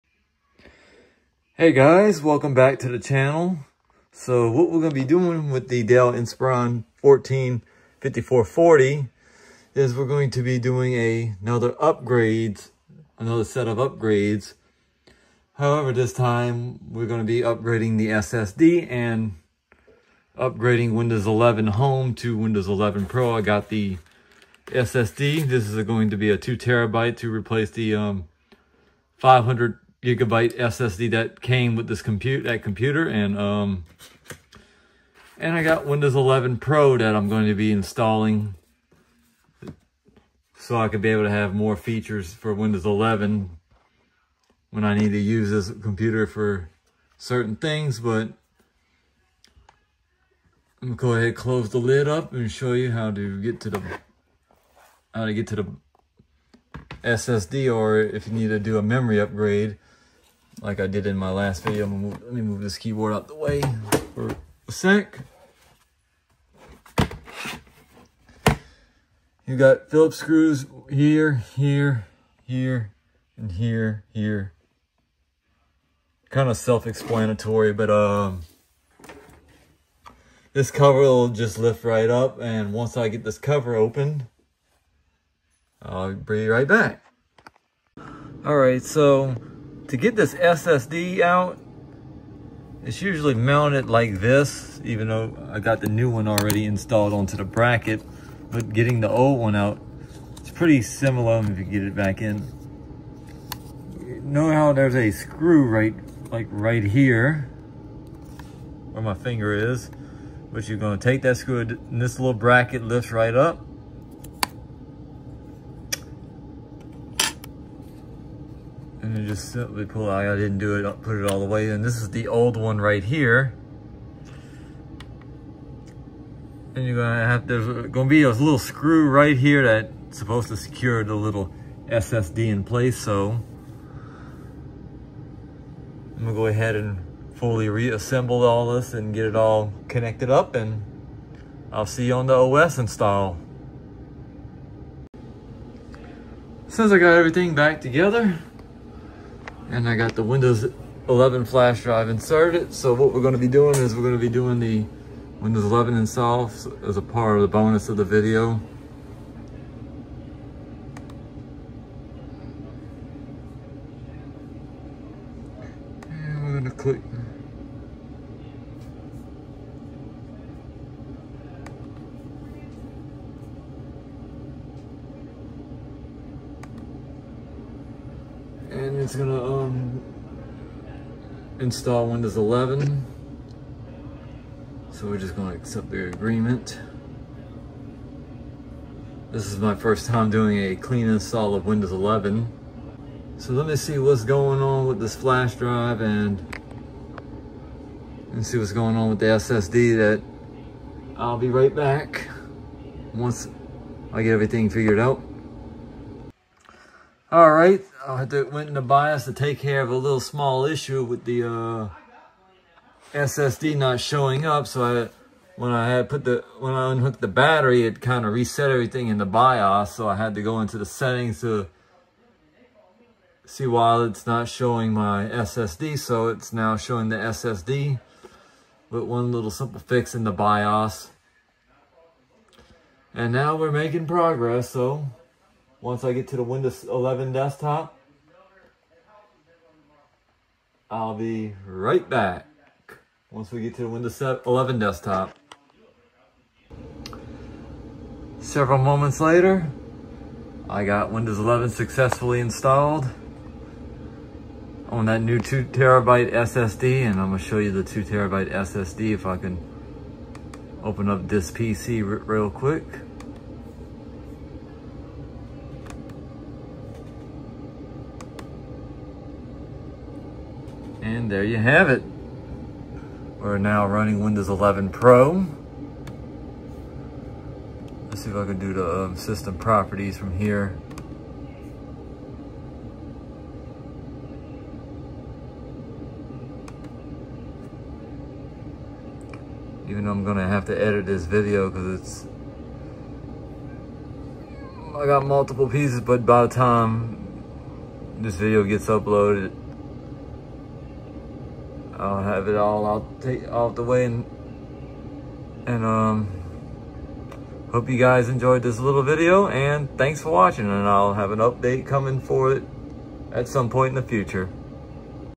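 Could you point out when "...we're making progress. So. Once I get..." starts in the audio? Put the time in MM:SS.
03:53.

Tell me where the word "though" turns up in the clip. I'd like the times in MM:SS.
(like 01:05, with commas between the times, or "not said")
01:35, 04:50.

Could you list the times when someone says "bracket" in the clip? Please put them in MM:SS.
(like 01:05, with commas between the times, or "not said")
01:37, 01:52.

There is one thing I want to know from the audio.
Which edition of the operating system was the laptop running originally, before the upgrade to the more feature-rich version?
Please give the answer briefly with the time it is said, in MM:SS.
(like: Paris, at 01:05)
Windows 11 Home, at 00:20.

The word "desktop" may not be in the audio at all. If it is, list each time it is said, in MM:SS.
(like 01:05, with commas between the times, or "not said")
03:57, 04:04.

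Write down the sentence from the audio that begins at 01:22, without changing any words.
And once I get this cover open, I'll be right back.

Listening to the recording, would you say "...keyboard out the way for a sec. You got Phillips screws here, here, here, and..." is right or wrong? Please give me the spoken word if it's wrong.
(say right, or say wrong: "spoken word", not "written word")
right.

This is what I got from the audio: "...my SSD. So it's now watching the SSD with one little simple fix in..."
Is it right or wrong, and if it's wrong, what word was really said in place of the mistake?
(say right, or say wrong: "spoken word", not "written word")
wrong: "showing", not "watching".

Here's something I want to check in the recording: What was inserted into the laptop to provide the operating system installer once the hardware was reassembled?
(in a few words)
Windows 11 flash drive.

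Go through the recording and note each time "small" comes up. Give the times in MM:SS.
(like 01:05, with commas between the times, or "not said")
03:30.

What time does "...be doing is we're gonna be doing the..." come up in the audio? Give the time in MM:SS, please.
02:33.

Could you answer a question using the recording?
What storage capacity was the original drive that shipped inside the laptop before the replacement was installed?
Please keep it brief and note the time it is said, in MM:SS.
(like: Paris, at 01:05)
500 gigabytes, at 00:29.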